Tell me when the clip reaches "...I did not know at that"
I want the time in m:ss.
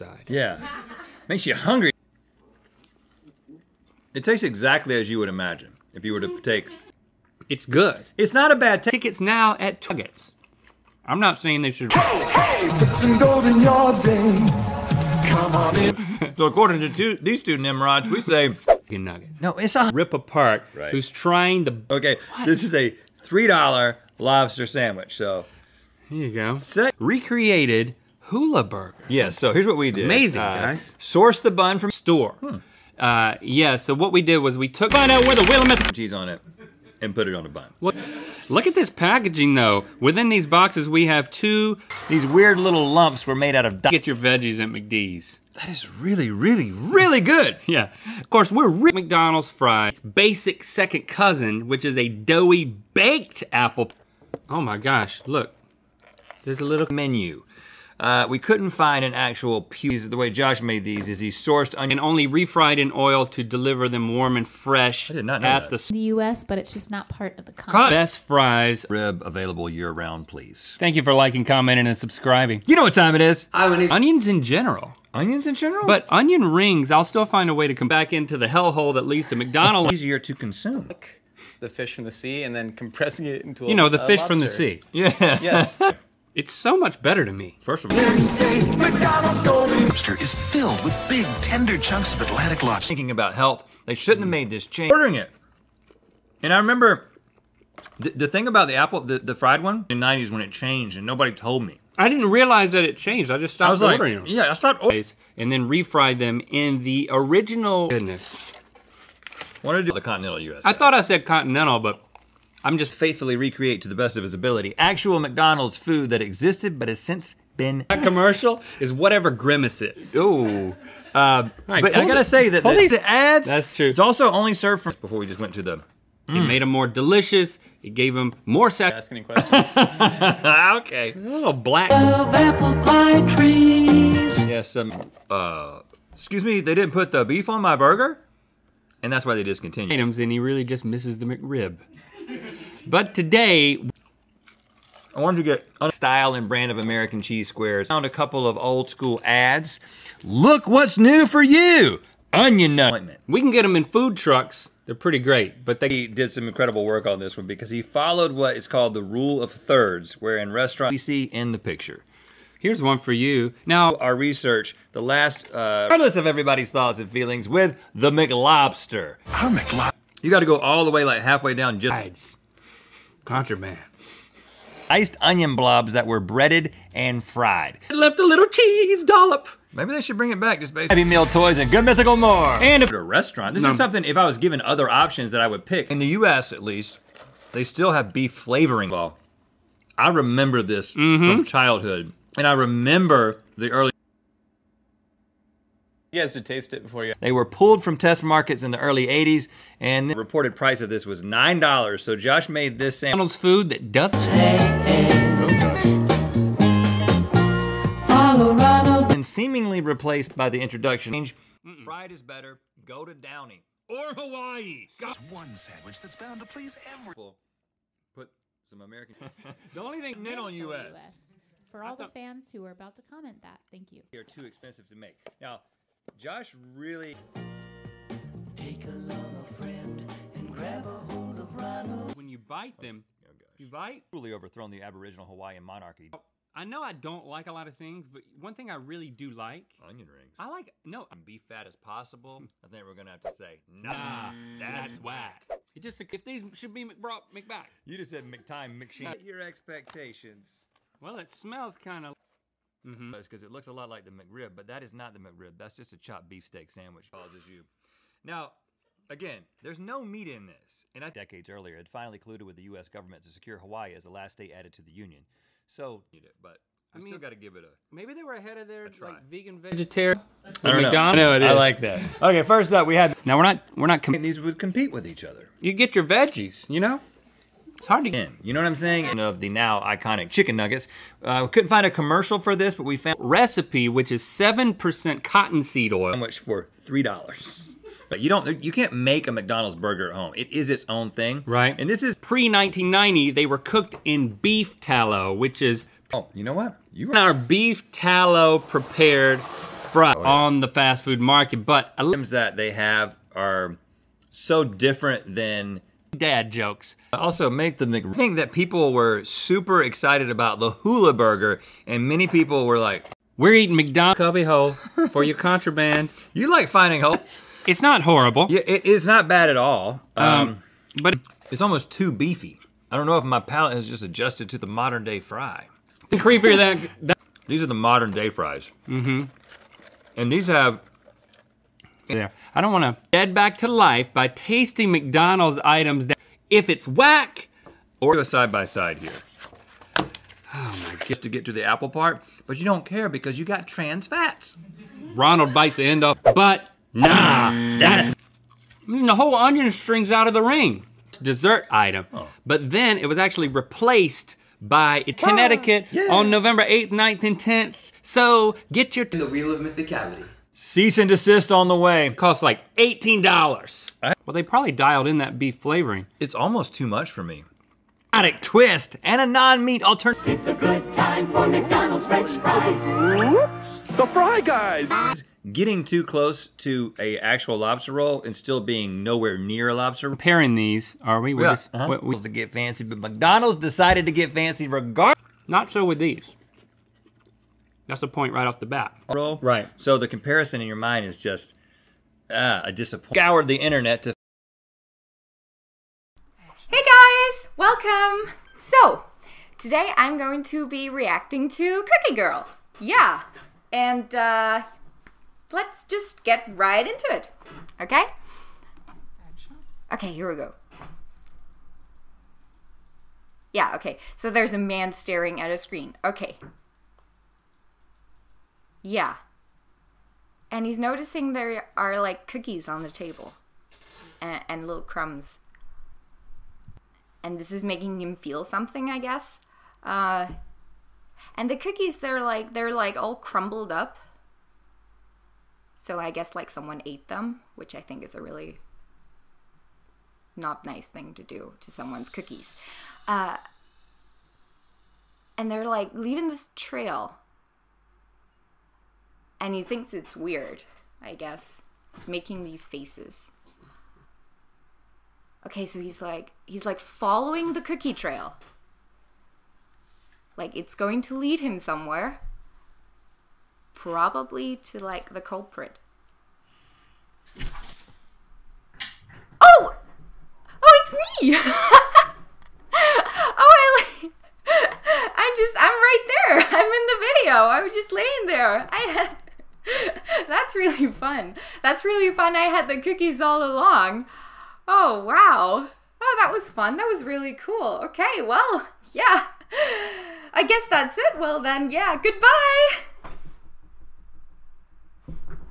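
1:05.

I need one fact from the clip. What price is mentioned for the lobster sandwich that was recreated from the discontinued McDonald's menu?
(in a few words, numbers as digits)
$3.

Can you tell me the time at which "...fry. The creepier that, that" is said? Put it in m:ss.
5:25.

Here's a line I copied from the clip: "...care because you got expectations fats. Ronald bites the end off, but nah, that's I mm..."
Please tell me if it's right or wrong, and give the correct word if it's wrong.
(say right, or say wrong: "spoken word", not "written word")
wrong: "trans", not "expectations".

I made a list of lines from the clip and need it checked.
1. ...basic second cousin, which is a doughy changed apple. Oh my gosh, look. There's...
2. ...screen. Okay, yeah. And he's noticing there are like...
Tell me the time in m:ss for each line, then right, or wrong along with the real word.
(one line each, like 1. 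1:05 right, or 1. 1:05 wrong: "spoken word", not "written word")
1. 0:49 wrong: "baked", not "changed"
2. 6:55 right.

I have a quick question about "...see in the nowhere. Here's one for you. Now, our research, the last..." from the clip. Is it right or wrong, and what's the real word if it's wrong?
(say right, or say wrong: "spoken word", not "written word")
wrong: "picture", not "nowhere".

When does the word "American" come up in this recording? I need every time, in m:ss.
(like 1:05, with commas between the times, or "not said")
2:26, 3:38.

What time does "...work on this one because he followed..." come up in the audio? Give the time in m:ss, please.
2:36.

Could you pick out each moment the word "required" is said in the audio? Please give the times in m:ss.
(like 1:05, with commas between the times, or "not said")
not said.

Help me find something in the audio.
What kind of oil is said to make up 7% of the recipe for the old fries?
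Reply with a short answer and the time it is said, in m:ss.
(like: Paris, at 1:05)
cottonseed oil, at 4:45.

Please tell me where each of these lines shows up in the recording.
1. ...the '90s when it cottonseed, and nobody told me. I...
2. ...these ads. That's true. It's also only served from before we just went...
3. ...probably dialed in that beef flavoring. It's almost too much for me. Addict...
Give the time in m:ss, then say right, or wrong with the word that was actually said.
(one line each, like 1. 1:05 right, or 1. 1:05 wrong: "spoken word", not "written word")
1. 1:39 wrong: "changed", not "cottonseed"
2. 2:02 right
3. 6:04 right.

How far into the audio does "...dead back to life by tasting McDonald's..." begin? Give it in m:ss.
5:33.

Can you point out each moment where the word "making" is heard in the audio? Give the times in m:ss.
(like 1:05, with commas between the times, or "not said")
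7:07, 7:32.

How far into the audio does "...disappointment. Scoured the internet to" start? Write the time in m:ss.
6:32.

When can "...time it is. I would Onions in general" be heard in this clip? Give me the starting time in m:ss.
1:12.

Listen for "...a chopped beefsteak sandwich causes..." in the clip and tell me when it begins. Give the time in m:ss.
4:15.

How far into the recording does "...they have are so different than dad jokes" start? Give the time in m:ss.
5:02.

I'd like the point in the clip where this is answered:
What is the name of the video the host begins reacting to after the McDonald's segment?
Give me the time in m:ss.
6:41.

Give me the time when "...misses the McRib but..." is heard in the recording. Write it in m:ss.
2:20.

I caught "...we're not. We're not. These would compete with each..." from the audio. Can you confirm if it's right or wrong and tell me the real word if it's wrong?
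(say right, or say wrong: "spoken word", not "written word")
right.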